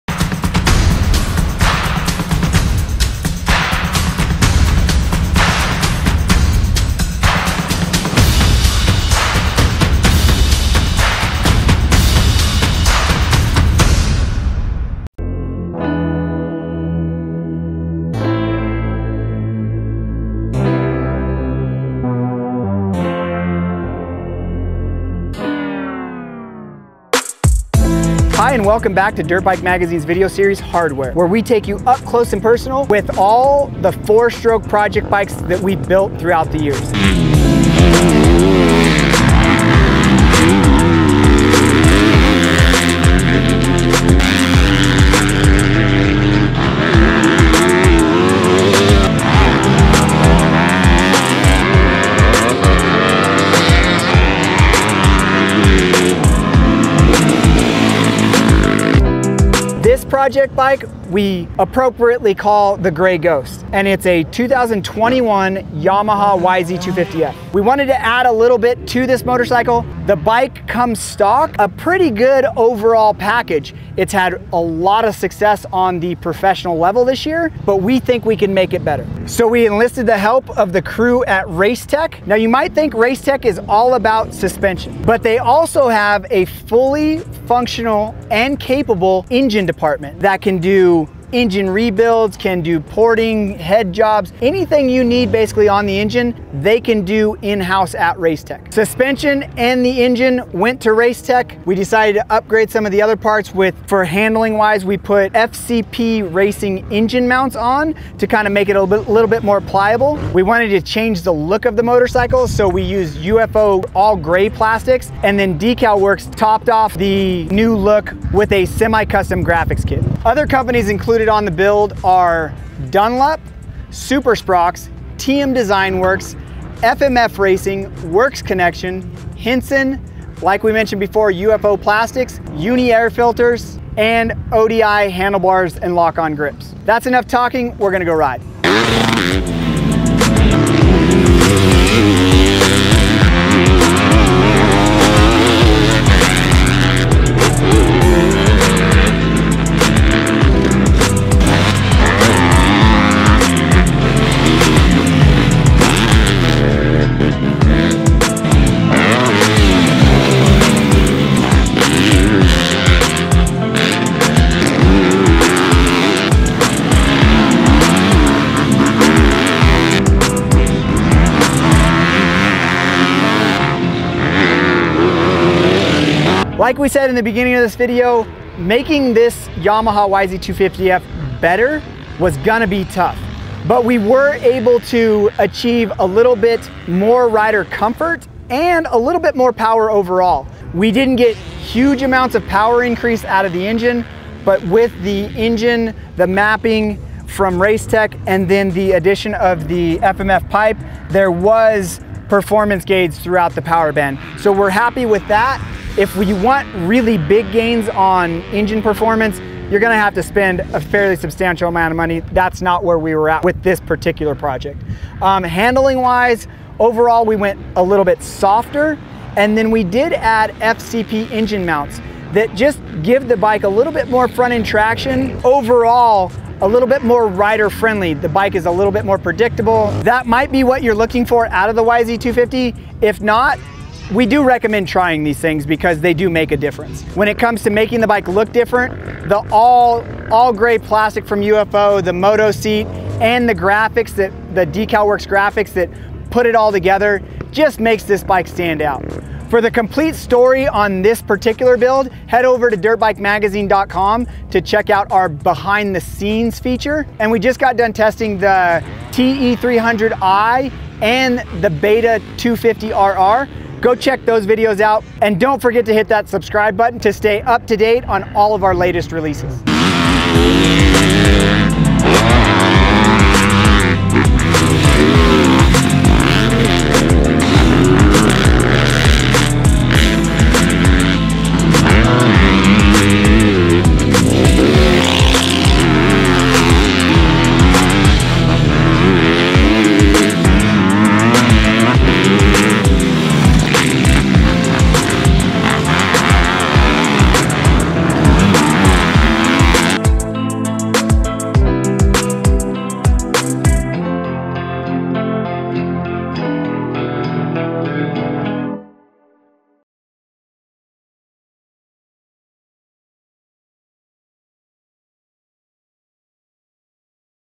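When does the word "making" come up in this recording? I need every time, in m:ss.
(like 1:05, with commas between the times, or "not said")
2:58, 3:57.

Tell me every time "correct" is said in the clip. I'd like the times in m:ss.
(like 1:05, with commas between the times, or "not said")
not said.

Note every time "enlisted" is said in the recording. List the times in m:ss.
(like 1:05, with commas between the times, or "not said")
1:19.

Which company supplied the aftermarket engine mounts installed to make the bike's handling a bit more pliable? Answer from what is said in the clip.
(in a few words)
FCP Racing.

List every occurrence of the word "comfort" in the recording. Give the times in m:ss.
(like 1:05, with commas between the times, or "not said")
3:07.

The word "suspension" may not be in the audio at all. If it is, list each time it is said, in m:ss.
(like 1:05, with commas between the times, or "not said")
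1:24, 1:38.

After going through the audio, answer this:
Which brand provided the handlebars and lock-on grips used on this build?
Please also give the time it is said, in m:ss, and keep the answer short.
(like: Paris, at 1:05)
ODI, at 2:14.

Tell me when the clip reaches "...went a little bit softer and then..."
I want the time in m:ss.
3:37.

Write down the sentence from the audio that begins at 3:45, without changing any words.
Overall, a little bit more rider friendly.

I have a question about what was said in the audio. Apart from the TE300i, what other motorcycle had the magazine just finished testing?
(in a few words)
Beta 250RR.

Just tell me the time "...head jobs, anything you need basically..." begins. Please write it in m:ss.
1:33.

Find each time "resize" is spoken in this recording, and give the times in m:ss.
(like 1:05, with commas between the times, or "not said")
not said.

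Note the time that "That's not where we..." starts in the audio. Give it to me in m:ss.
3:32.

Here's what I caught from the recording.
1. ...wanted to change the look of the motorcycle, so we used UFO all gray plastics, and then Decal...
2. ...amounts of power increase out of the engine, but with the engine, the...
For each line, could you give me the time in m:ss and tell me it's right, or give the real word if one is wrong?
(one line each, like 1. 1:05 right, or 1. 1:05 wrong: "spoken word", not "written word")
1. 1:50 right
2. 3:12 right.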